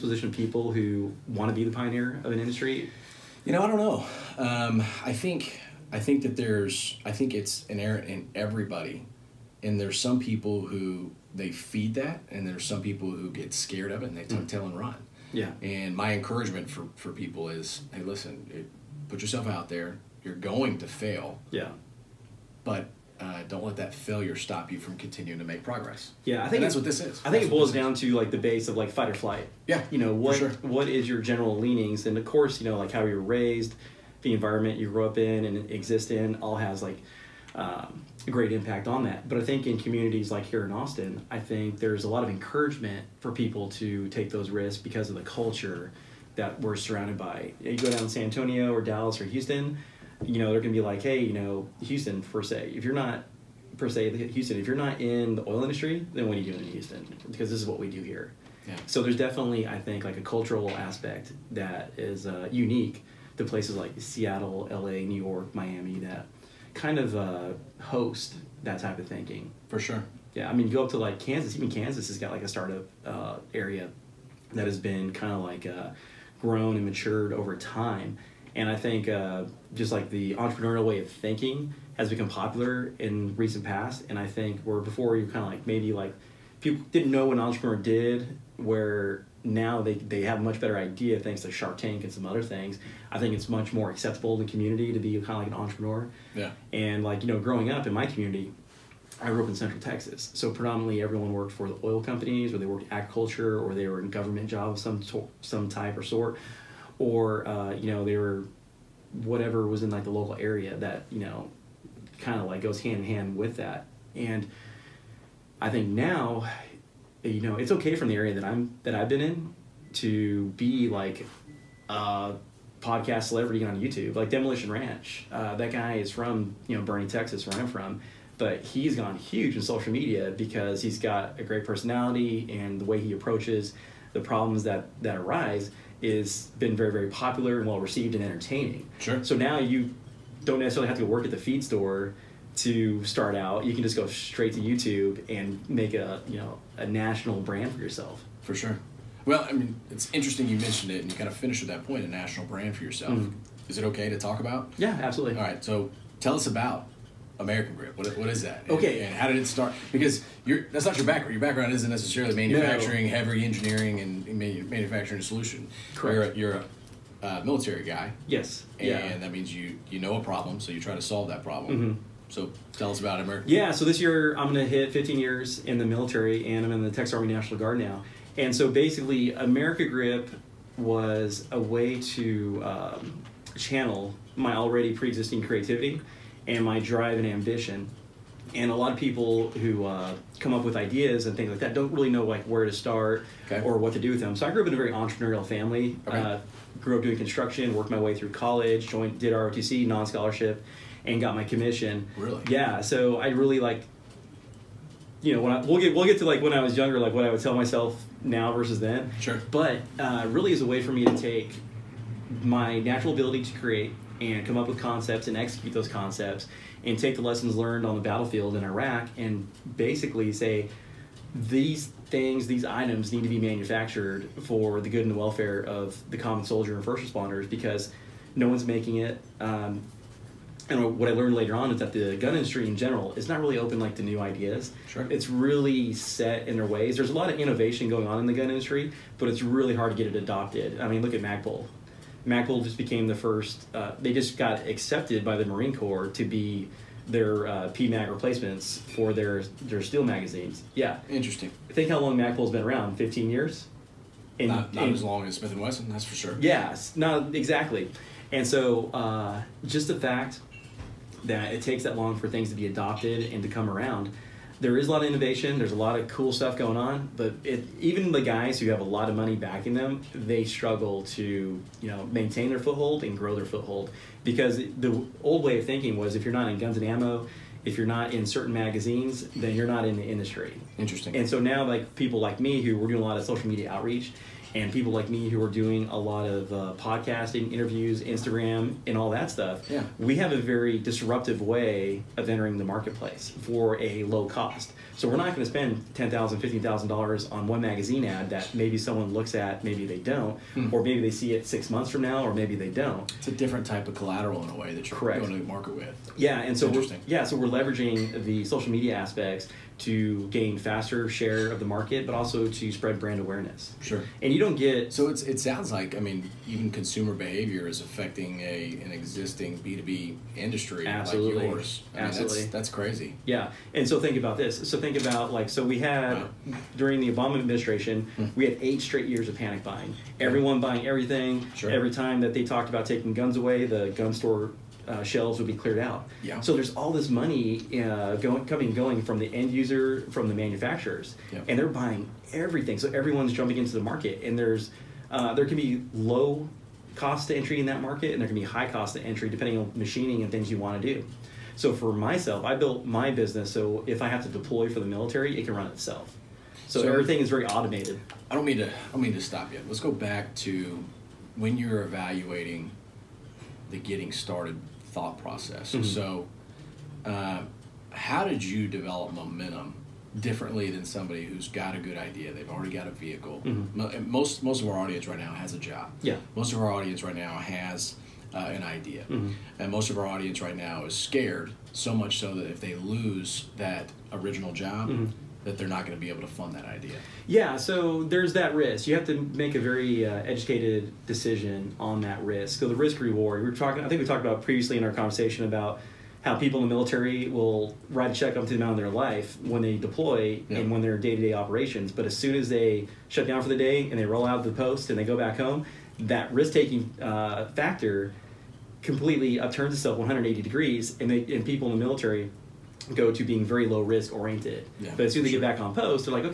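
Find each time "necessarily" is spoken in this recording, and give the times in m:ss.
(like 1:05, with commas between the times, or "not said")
2:20, 2:41.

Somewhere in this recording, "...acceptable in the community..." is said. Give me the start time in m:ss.
1:33.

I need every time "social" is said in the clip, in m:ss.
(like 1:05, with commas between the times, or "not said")
2:09, 4:43, 5:08.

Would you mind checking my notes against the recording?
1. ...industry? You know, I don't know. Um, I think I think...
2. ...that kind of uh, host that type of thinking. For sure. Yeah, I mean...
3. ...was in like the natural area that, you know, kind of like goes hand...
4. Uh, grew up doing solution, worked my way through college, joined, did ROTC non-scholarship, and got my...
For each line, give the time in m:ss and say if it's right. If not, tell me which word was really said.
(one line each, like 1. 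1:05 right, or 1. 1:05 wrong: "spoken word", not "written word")
1. 0:02 right
2. 1:06 right
3. 1:49 wrong: "local", not "natural"
4. 3:16 wrong: "construction", not "solution".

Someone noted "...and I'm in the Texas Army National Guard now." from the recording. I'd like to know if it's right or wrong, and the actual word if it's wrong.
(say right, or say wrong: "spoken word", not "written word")
right.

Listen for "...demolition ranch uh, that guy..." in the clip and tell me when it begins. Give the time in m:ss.
2:04.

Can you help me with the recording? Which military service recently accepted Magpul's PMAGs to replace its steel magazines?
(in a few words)
Marine Corps.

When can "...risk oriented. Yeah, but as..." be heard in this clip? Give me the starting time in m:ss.
6:53.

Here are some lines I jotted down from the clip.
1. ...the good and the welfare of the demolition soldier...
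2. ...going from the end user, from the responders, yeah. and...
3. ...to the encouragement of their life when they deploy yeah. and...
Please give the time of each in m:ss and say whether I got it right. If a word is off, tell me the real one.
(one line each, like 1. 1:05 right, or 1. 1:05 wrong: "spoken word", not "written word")
1. 3:44 wrong: "common", not "demolition"
2. 5:38 wrong: "manufacturers", not "responders"
3. 6:38 wrong: "amount", not "encouragement".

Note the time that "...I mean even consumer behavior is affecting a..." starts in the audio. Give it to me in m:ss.
5:15.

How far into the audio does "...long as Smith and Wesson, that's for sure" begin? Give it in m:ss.
4:15.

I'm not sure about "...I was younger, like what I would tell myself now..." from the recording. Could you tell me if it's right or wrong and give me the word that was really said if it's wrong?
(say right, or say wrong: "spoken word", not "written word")
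right.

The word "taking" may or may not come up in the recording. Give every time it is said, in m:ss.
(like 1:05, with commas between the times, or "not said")
5:32, 6:46.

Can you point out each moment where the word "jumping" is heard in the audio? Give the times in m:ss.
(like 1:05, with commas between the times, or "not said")
5:43.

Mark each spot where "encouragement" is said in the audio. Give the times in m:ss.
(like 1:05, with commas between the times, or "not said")
0:16, 0:42.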